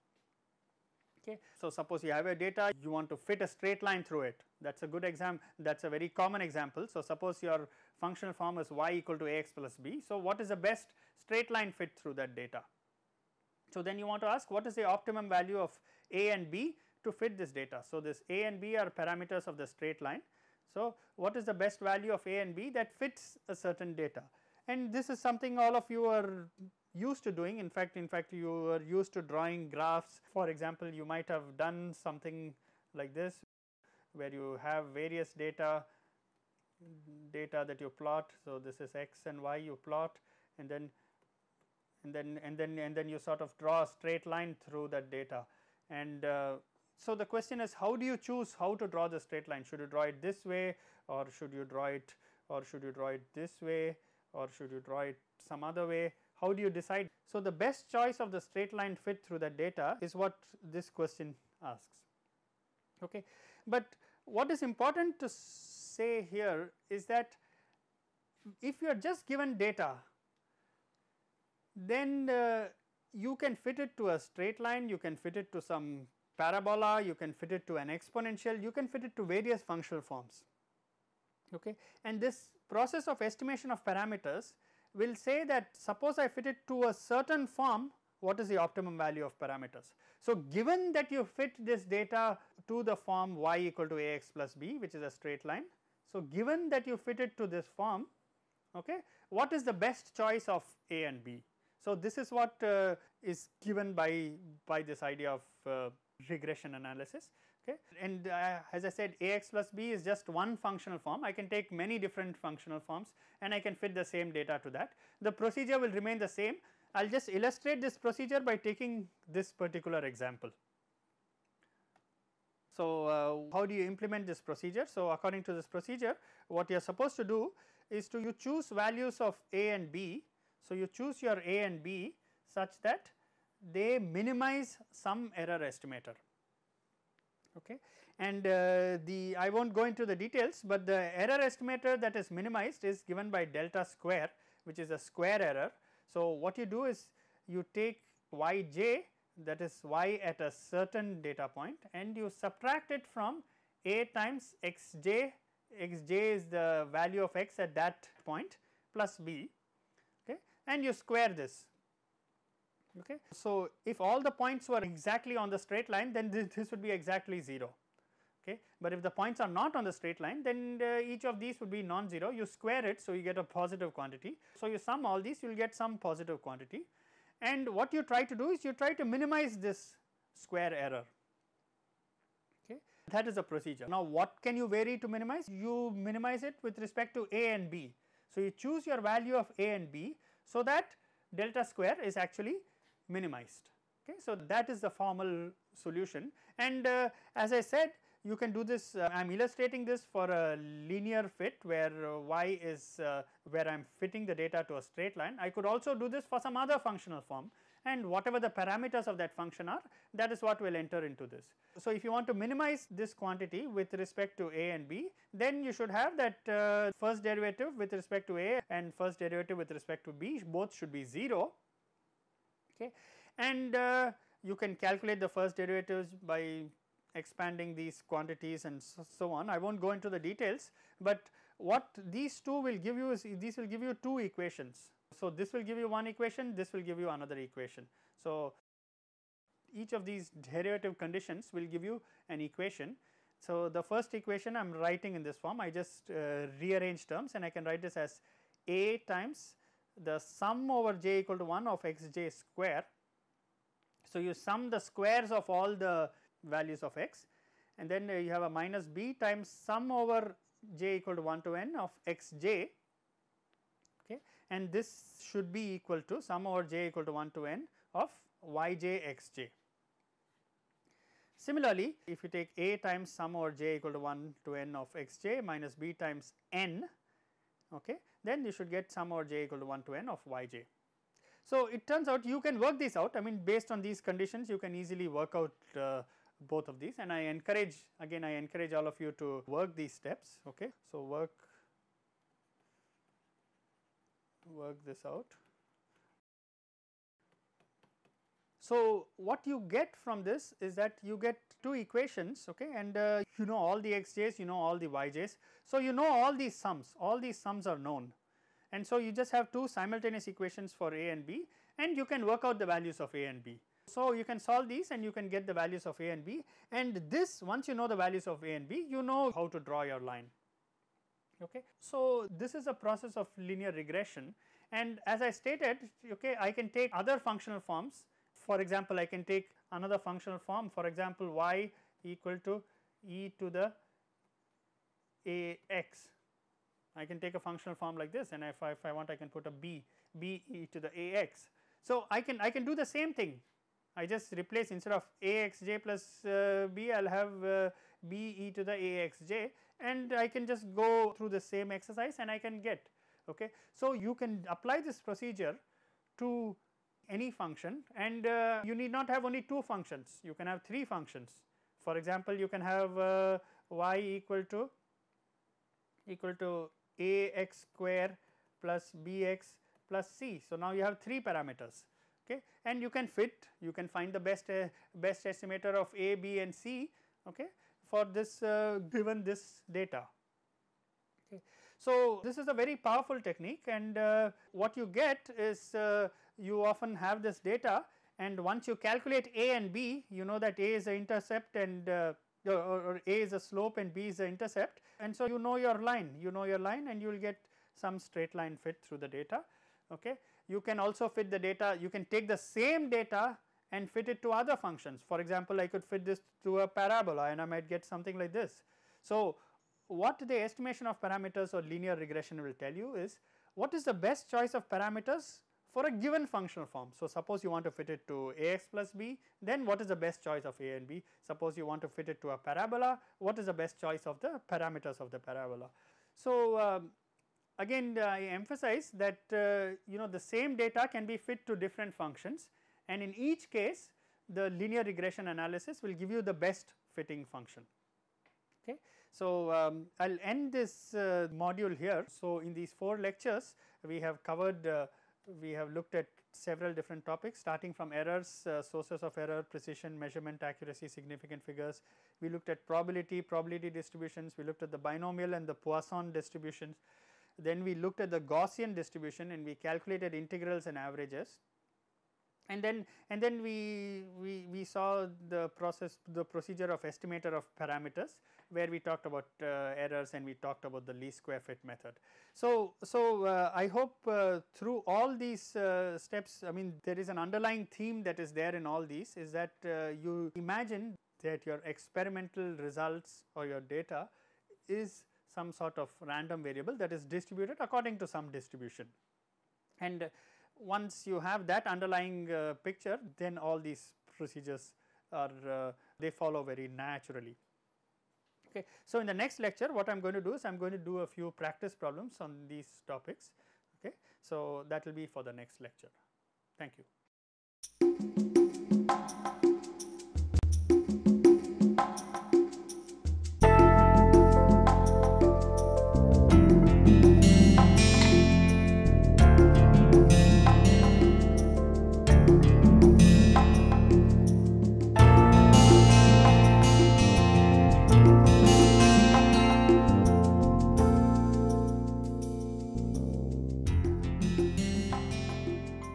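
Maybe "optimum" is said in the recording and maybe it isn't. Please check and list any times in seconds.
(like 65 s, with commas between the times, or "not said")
14 s, 88 s.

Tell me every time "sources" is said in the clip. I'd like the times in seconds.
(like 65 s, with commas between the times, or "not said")
448 s.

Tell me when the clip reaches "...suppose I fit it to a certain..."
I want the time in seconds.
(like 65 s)
85 s.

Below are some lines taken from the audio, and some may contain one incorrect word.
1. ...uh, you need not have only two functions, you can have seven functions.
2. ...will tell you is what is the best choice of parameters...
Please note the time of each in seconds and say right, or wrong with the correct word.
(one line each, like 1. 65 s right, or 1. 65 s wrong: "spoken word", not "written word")
1. 358 s wrong: "three", not "seven"
2. 412 s right.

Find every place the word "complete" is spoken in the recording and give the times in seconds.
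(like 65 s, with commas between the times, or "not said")
not said.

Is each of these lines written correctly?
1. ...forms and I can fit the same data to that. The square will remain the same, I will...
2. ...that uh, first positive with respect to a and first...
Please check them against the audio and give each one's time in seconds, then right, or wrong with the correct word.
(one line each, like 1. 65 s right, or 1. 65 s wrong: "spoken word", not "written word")
1. 112 s wrong: "procedure", not "square"
2. 216 s wrong: "derivative", not "positive".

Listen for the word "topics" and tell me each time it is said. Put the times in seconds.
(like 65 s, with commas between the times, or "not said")
447 s, 502 s.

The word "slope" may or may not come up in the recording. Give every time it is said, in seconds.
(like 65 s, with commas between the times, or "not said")
393 s.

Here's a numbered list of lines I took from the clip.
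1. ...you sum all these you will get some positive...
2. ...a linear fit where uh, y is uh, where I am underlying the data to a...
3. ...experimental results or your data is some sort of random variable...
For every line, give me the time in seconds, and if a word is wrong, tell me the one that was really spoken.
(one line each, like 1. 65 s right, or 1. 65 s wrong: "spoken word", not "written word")
1. 174 s right
2. 200 s wrong: "fitting", not "underlying"
3. 481 s right.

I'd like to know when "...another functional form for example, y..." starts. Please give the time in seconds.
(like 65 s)
329 s.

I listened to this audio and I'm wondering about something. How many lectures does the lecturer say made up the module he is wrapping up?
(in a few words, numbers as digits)
4.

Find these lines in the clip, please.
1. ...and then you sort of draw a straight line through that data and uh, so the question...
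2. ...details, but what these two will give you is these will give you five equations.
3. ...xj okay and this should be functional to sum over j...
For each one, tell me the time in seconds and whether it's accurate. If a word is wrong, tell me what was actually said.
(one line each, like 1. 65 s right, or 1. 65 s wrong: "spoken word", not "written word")
1. 42 s right
2. 230 s wrong: "two", not "five"
3. 262 s wrong: "equal", not "functional".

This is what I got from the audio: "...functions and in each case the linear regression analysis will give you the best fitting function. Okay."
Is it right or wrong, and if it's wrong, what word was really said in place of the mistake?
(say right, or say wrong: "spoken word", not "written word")
right.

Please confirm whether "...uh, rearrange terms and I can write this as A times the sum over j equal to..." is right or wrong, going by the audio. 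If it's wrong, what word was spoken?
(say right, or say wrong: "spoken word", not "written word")
right.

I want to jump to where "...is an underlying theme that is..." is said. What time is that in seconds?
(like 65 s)
476 s.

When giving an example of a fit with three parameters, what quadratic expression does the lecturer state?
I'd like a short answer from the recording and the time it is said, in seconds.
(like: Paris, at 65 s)
ax^2 + bx + c, at 366 s.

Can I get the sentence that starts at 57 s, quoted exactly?
So, the best choice of the straight line fit through the data is what this question asks.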